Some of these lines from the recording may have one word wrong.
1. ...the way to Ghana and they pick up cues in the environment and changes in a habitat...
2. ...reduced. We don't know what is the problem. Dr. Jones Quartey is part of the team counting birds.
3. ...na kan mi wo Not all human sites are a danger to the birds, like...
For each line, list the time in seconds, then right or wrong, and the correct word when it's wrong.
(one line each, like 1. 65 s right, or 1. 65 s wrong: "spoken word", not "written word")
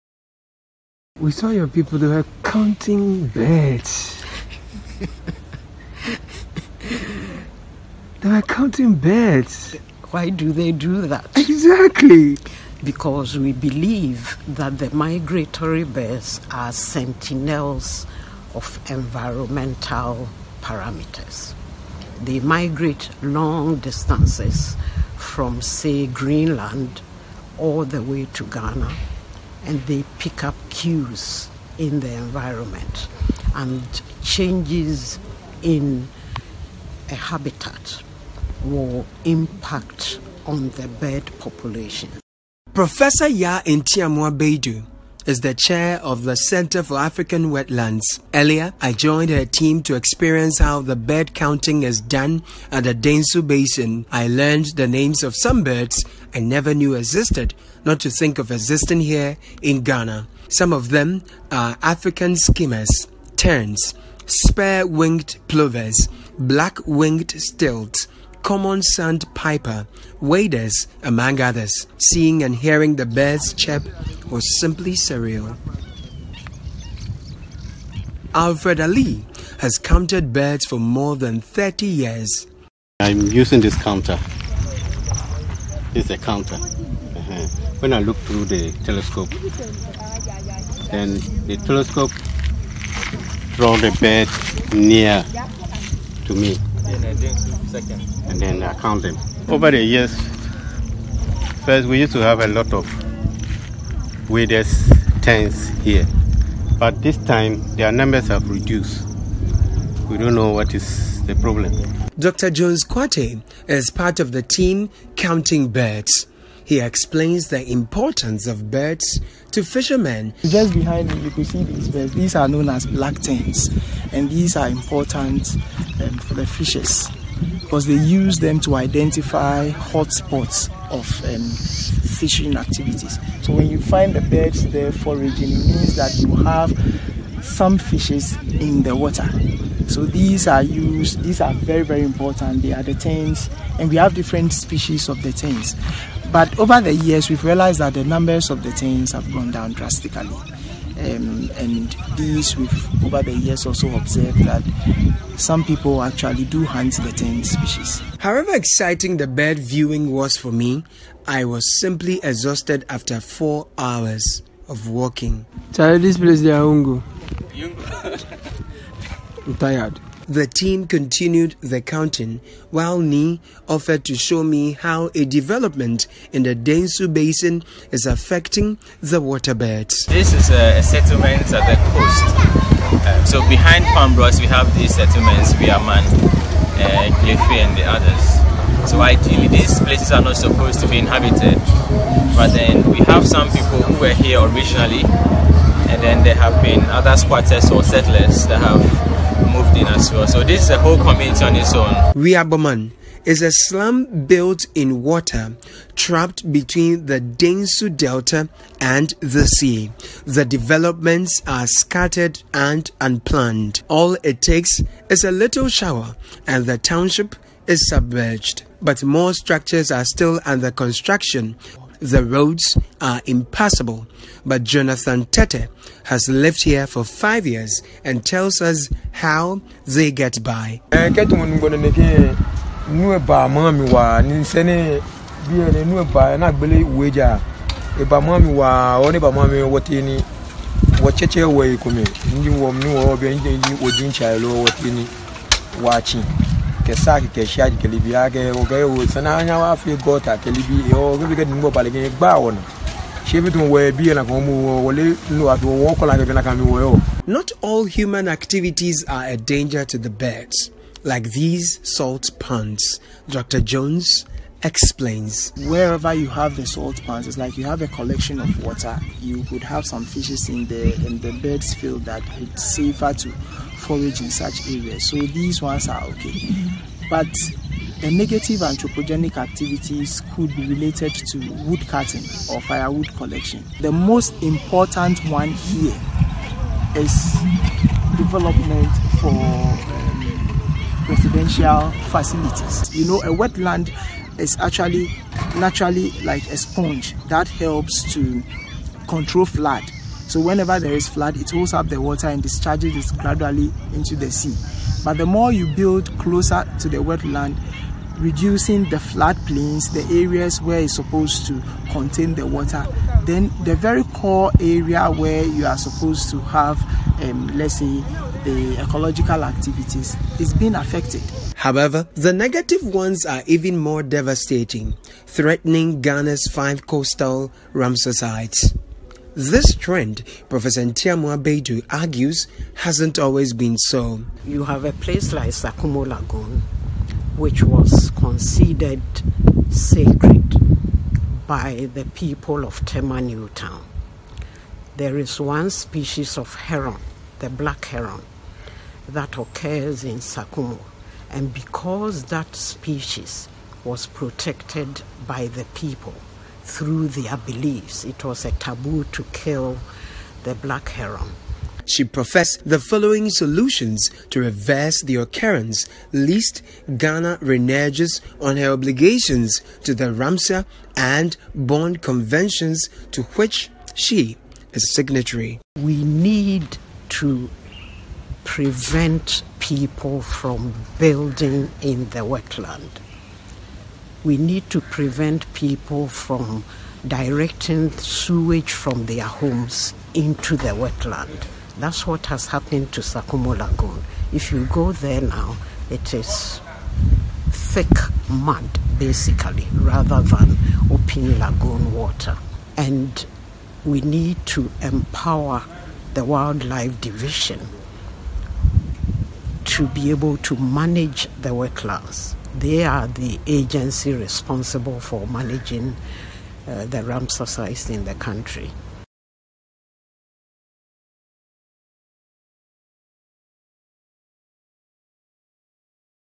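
1. 27 s right
2. 108 s right
3. 256 s wrong: "activities", not "sites".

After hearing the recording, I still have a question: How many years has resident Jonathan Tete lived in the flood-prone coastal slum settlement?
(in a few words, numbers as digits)
5.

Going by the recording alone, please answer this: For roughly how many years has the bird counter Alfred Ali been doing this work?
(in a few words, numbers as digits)
30.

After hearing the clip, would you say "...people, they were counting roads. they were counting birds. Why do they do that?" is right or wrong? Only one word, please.
wrong.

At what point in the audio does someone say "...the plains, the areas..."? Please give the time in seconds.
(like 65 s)
308 s.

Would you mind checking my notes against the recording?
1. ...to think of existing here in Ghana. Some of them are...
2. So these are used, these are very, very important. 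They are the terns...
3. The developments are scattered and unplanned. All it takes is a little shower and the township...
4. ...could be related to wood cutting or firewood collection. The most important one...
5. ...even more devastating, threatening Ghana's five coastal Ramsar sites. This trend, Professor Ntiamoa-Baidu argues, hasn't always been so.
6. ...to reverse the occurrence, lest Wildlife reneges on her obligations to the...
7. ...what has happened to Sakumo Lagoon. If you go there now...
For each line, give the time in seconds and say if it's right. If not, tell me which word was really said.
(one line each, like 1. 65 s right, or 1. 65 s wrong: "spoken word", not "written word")
1. 58 s right
2. 139 s right
3. 210 s right
4. 280 s right
5. 323 s right
6. 364 s wrong: "Ghana", not "Wildlife"
7. 392 s right.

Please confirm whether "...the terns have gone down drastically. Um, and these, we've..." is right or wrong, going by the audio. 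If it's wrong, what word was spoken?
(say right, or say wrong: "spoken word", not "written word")
right.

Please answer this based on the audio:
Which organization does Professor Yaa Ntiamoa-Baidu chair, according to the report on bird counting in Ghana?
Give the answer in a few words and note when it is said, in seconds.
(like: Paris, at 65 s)
Center for African Wetlands, at 46 s.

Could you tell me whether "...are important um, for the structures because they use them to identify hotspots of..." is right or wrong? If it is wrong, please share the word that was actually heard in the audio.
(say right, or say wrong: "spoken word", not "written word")
wrong: "fishes", not "structures".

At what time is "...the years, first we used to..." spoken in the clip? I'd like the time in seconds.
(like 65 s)
99 s.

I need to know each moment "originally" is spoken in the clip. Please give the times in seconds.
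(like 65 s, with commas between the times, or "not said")
194 s.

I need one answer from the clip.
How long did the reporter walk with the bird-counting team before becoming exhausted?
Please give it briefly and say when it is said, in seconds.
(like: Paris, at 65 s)
4 hours, at 163 s.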